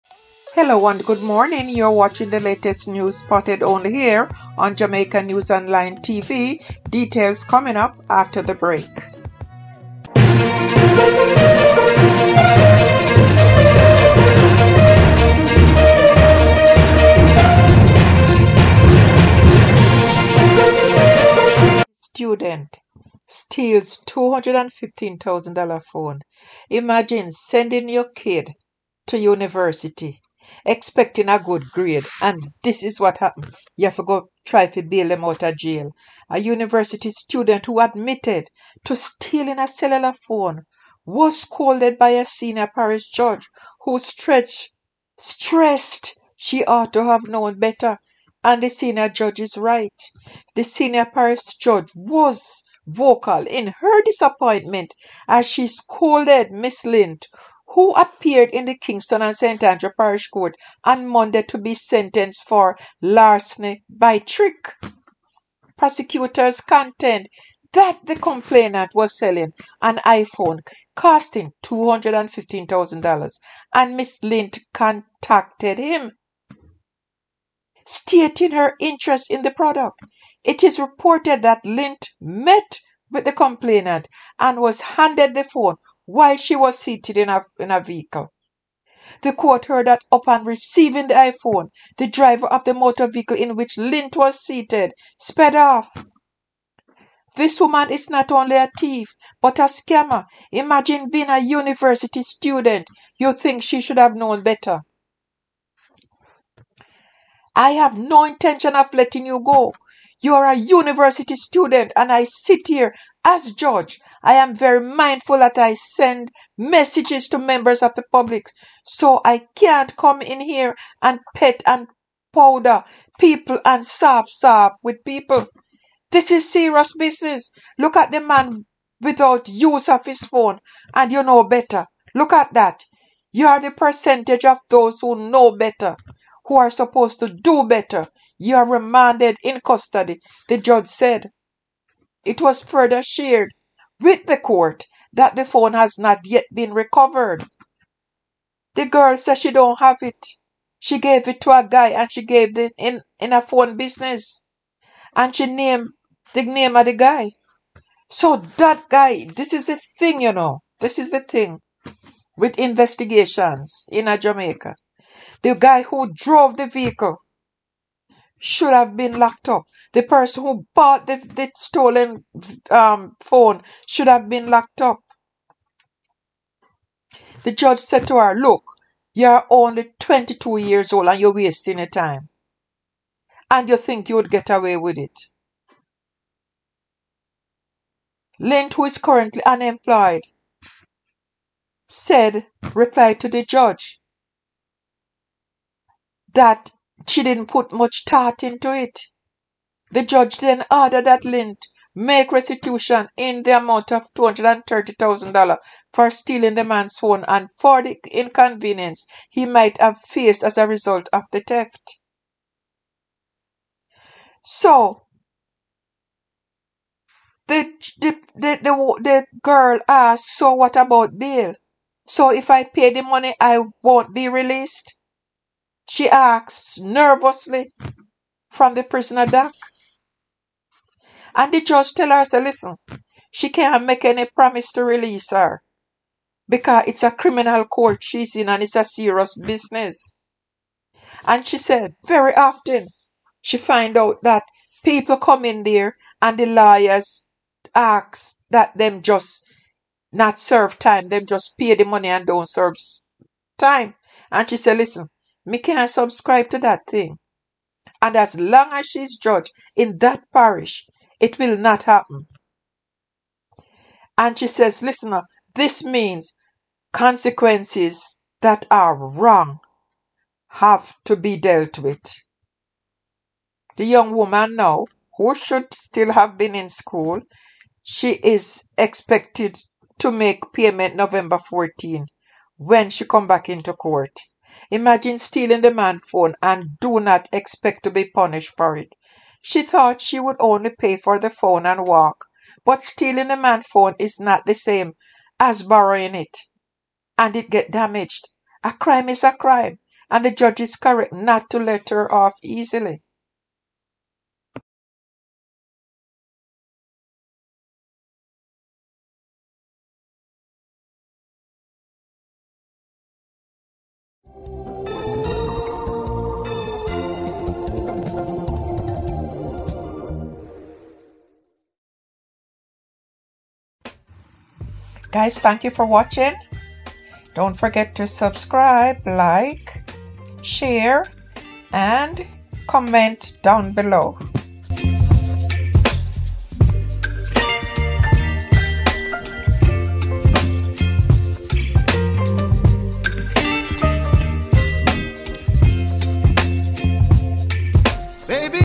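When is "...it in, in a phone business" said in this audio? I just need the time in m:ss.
2:32.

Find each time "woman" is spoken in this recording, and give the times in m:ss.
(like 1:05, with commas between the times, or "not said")
1:37, 4:34.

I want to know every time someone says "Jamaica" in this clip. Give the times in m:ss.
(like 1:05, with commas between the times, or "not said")
0:04, 2:44.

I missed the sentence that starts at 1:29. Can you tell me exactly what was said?
The court heard that upon receiving the iPhone, the driver of the motor vehicle in which Lind was seated sped off.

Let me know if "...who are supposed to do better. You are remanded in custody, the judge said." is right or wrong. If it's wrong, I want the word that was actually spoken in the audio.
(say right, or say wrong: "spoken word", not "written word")
right.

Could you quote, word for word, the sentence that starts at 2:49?
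The person who bought the, the stolen um, phone should have been locked up.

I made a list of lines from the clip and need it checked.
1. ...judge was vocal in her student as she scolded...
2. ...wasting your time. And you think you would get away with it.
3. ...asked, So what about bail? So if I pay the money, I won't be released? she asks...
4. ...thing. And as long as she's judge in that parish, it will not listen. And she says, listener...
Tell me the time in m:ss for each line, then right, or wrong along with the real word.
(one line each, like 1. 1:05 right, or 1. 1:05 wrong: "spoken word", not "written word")
1. 0:51 wrong: "disappointment", not "student"
2. 3:01 right
3. 3:39 right
4. 4:16 wrong: "happen", not "listen".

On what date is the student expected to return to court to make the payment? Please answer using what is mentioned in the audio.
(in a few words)
November 14.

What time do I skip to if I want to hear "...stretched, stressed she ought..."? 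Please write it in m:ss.
0:43.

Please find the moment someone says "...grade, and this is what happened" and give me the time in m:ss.
0:31.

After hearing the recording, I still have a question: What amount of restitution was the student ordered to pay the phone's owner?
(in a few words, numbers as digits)
$230,000.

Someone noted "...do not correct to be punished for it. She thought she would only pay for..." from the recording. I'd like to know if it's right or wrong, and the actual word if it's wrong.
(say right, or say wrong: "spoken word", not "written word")
wrong: "expect", not "correct".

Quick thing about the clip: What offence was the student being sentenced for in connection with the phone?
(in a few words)
Larceny by trick.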